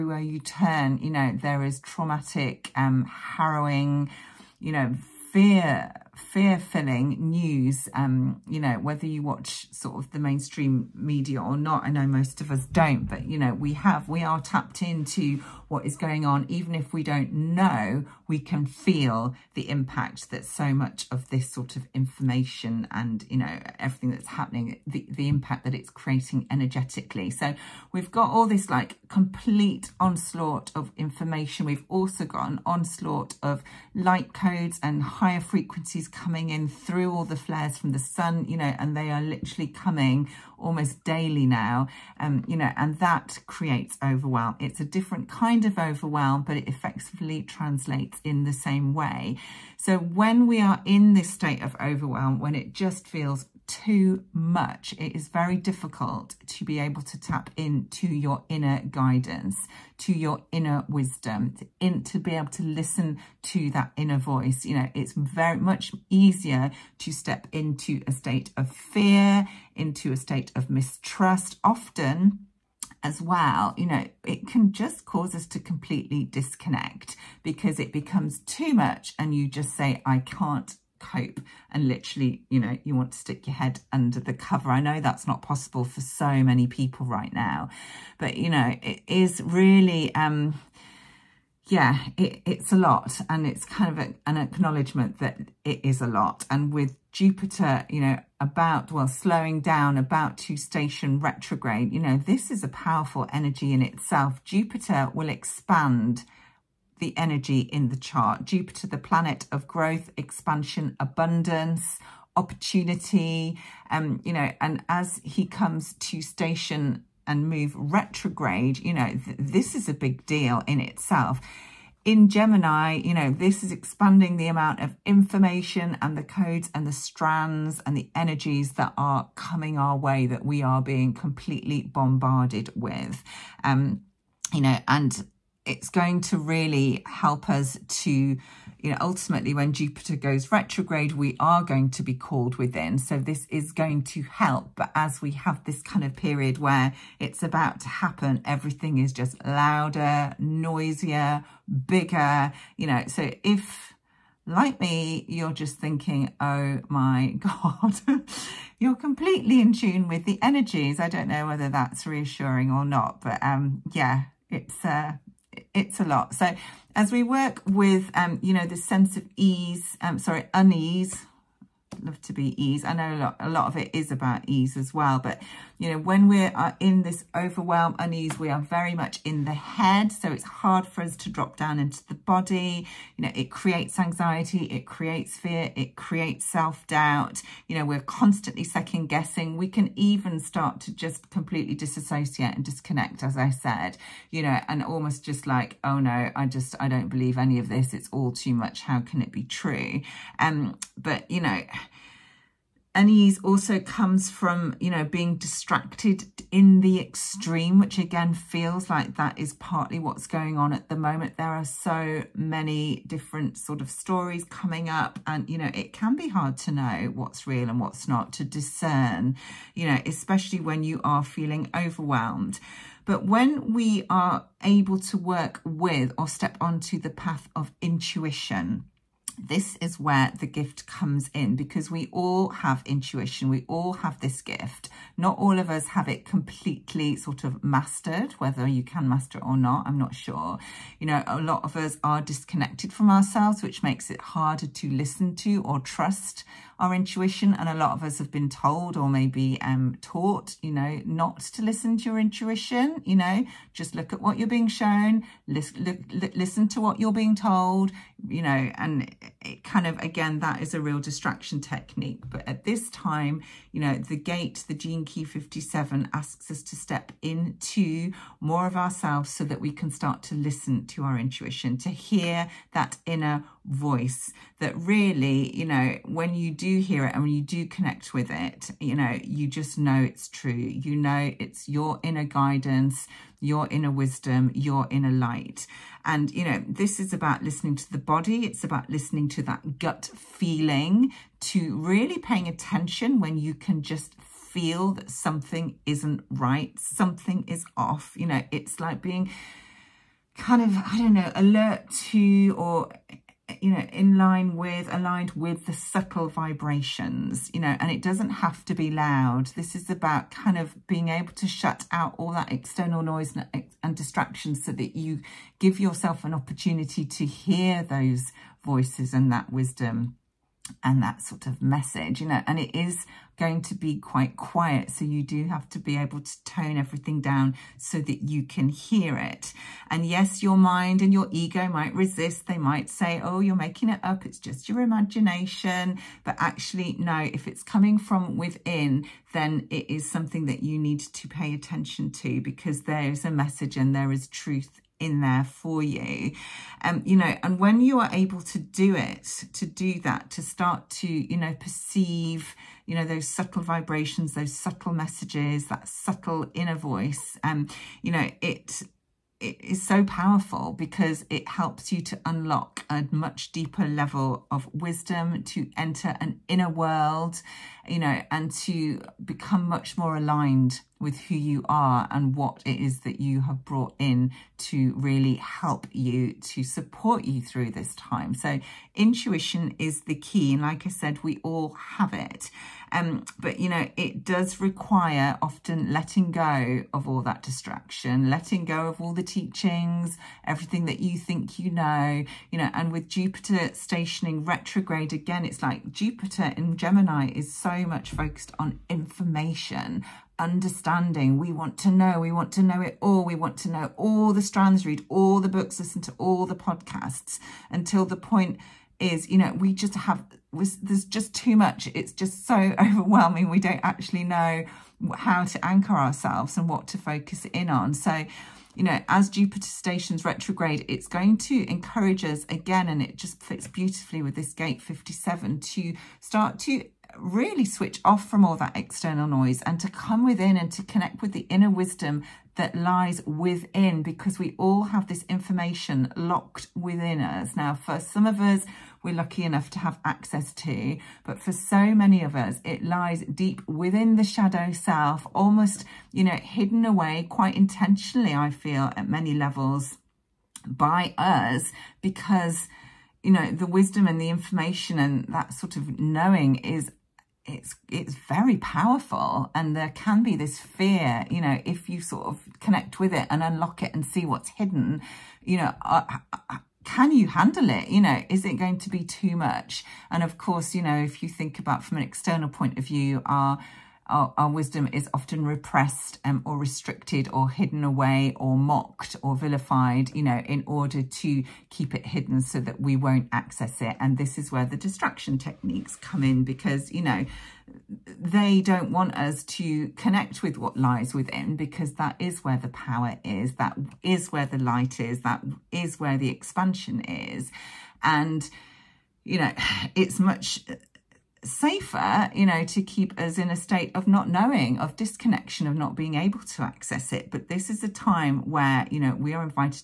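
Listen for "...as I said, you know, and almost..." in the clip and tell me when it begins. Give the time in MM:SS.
03:13.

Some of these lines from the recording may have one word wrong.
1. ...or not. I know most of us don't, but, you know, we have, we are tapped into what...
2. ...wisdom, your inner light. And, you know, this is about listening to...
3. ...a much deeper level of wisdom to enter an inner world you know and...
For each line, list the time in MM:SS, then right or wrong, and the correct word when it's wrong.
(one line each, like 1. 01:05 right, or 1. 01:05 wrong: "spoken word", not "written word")
1. 00:11 right
2. 04:43 right
3. 06:02 right.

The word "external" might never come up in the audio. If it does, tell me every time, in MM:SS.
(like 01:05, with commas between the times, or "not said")
05:12, 07:08, 07:52.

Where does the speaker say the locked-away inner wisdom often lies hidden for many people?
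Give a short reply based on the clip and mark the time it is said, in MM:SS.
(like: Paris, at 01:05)
The shadow self, at 07:24.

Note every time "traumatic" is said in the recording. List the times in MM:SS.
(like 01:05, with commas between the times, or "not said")
00:01.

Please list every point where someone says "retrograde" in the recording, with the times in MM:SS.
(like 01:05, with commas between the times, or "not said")
01:41, 01:57, 02:20, 06:34, 07:00.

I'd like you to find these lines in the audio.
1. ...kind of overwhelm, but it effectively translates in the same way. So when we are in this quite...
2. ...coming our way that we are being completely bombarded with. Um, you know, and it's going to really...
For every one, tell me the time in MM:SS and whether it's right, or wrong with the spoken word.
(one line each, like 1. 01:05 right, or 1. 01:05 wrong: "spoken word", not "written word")
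1. 00:45 wrong: "state", not "quite"
2. 02:09 right.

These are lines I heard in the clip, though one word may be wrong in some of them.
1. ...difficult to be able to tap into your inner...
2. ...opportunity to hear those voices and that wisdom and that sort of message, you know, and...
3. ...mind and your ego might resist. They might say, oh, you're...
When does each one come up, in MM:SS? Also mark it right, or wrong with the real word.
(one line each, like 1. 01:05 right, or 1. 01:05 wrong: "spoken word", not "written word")
1. 00:55 right
2. 05:16 right
3. 05:30 right.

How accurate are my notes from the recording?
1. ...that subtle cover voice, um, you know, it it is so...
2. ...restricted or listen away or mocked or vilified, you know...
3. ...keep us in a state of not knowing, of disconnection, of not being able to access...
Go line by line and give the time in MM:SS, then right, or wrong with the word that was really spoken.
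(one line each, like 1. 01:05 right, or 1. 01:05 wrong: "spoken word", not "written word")
1. 05:55 wrong: "inner", not "cover"
2. 07:56 wrong: "hidden", not "listen"
3. 08:22 right.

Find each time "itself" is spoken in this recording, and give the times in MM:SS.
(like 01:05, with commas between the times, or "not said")
01:43, 02:00.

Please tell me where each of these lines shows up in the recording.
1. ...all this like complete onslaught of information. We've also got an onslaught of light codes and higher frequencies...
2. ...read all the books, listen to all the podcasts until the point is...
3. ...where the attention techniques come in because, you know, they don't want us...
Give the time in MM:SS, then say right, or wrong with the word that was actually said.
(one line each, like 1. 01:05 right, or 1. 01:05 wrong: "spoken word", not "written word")
1. 00:28 right
2. 06:44 right
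3. 08:04 wrong: "distraction", not "attention".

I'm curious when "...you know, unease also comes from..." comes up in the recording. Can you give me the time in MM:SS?
03:21.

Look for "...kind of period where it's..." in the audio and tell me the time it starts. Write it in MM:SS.
02:25.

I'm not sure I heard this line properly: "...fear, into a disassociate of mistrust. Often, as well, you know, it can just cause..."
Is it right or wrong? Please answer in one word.
wrong.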